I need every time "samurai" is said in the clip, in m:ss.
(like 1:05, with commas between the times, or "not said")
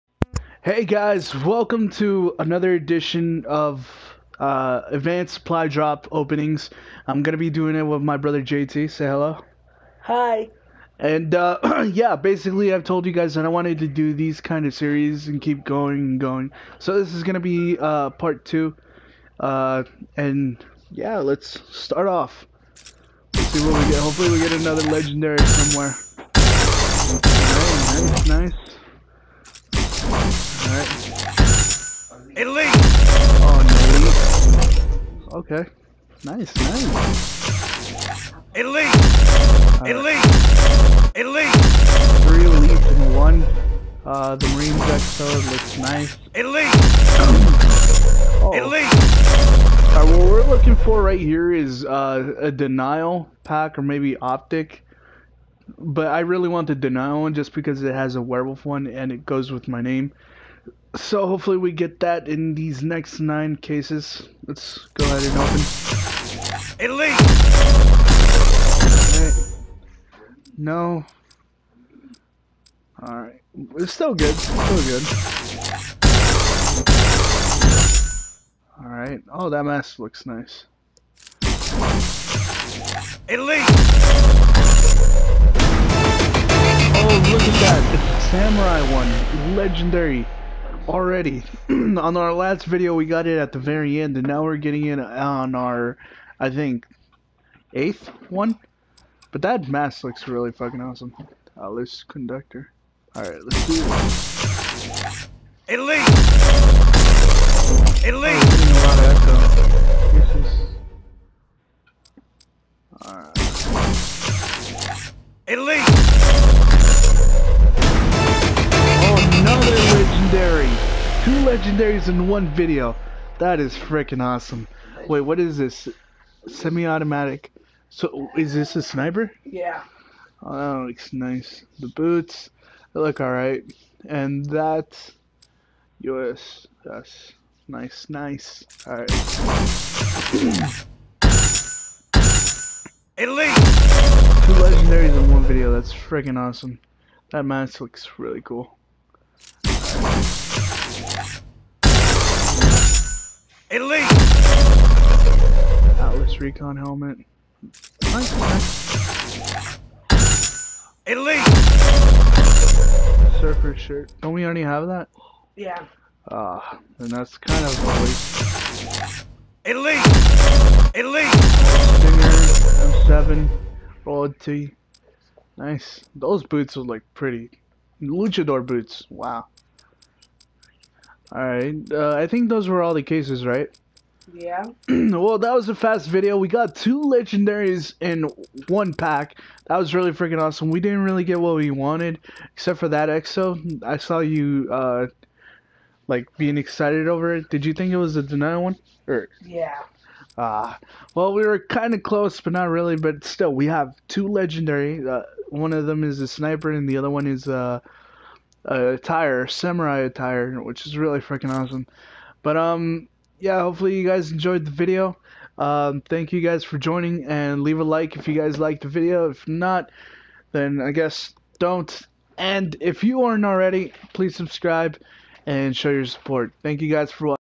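1:28, 3:29.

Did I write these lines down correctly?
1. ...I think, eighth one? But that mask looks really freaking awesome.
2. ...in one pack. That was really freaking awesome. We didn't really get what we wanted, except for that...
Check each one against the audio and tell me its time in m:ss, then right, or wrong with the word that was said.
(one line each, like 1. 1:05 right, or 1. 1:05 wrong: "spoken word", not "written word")
1. 1:36 wrong: "fucking", not "freaking"
2. 3:07 right.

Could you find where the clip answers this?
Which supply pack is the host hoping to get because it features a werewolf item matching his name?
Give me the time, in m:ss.
0:52.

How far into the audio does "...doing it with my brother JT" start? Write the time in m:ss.
0:07.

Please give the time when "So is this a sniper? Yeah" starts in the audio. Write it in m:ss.
2:07.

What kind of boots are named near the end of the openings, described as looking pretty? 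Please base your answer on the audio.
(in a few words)
Luchador boots.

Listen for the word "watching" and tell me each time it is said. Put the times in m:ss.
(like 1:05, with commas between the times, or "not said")
3:47.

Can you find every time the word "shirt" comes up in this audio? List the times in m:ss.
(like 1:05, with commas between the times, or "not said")
2:43.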